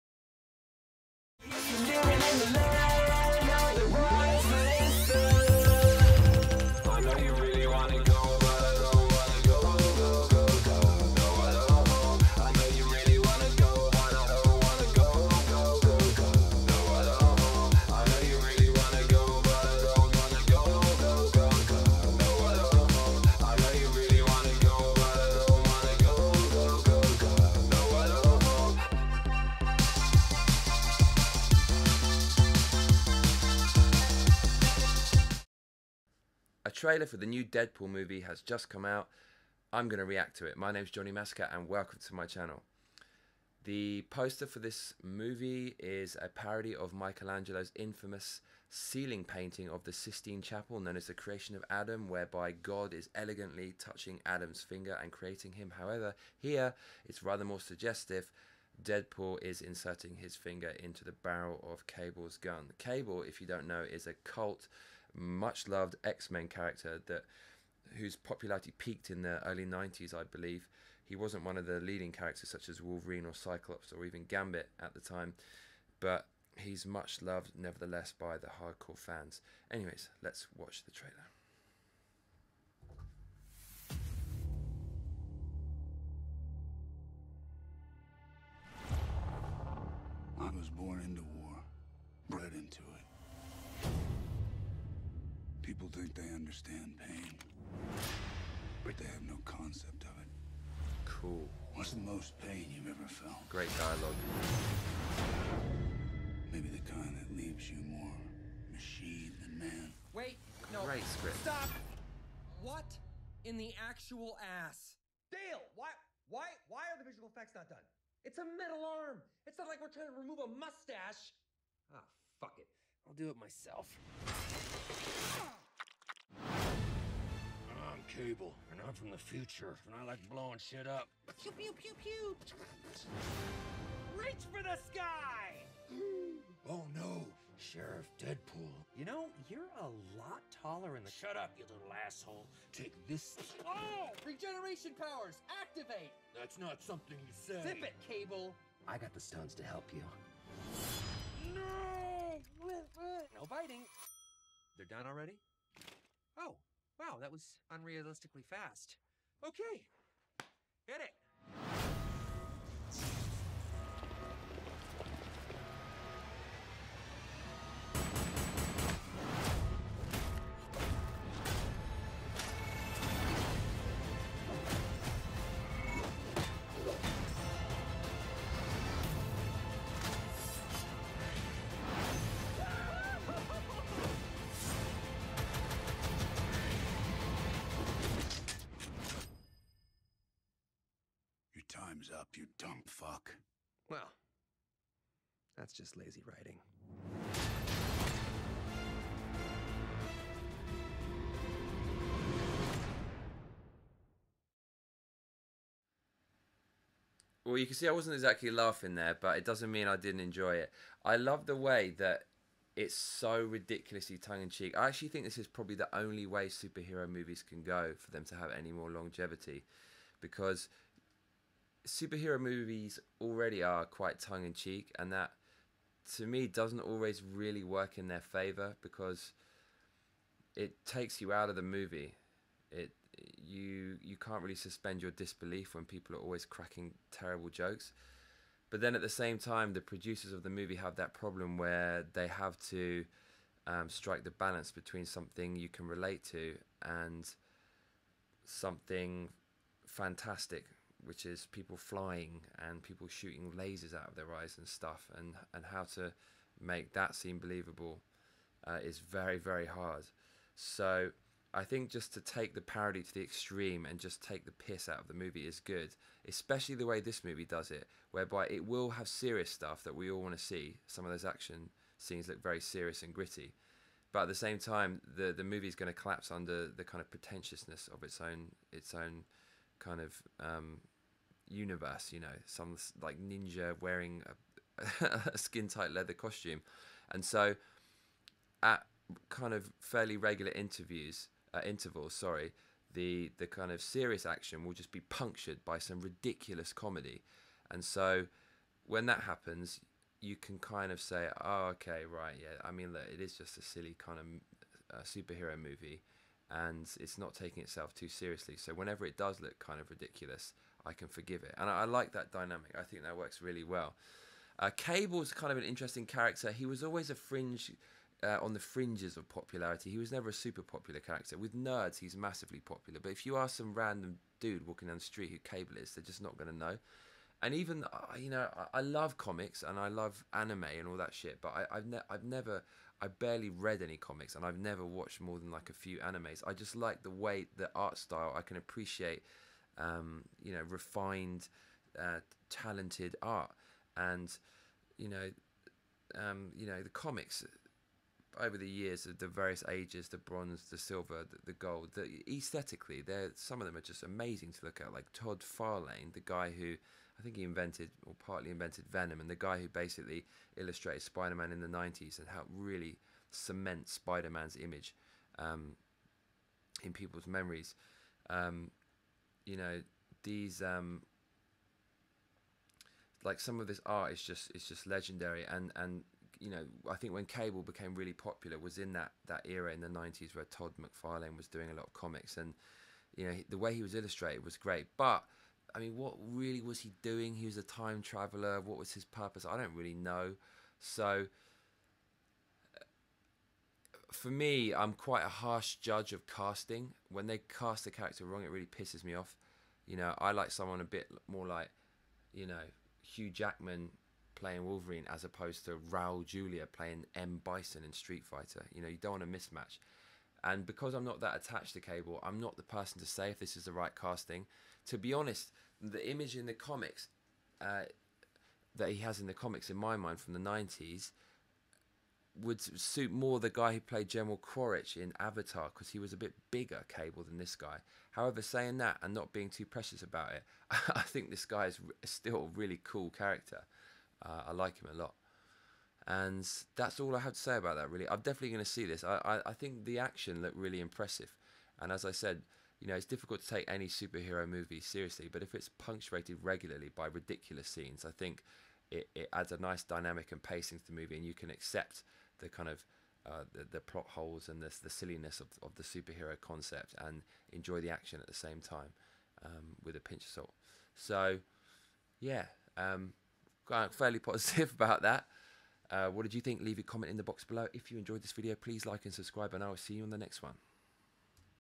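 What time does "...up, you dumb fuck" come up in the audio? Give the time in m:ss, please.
3:12.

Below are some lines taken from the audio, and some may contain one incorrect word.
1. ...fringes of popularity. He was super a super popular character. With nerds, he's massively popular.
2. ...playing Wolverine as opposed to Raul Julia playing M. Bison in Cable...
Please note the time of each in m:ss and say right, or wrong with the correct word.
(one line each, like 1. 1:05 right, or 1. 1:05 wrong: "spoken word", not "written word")
1. 5:18 wrong: "never", not "super"
2. 6:44 wrong: "Street", not "Cable".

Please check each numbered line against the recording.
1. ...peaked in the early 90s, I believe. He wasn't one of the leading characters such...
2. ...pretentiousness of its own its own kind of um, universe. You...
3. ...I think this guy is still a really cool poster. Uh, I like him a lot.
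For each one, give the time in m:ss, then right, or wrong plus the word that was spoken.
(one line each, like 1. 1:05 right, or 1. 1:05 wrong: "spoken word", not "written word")
1. 1:08 right
2. 4:37 right
3. 7:10 wrong: "character", not "poster".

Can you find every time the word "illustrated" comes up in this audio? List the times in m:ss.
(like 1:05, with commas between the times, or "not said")
6:00, 6:23.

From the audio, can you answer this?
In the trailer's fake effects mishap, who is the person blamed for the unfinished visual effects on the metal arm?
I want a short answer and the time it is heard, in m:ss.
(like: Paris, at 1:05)
Dale, at 1:55.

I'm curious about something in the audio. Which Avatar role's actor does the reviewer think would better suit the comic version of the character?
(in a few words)
General Quaritch.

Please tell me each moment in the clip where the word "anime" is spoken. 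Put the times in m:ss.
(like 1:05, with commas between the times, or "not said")
5:30, 5:35.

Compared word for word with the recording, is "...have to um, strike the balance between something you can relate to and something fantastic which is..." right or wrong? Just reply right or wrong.
right.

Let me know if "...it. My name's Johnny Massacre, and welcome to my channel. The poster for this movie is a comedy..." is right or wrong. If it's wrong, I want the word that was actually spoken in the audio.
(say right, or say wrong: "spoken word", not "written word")
wrong: "parody", not "comedy".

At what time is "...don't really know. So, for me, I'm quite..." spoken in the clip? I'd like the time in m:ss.
6:29.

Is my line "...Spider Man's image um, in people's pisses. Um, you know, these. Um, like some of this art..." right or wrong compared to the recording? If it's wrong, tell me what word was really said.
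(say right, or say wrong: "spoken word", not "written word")
wrong: "memories", not "pisses".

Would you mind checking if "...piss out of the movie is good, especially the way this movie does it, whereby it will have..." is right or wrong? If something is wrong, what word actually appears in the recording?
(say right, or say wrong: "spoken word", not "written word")
right.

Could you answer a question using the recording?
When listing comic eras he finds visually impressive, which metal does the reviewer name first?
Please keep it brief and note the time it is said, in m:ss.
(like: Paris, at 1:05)
bronze, at 5:50.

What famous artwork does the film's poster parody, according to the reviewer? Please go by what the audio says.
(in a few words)
Creation of Adam.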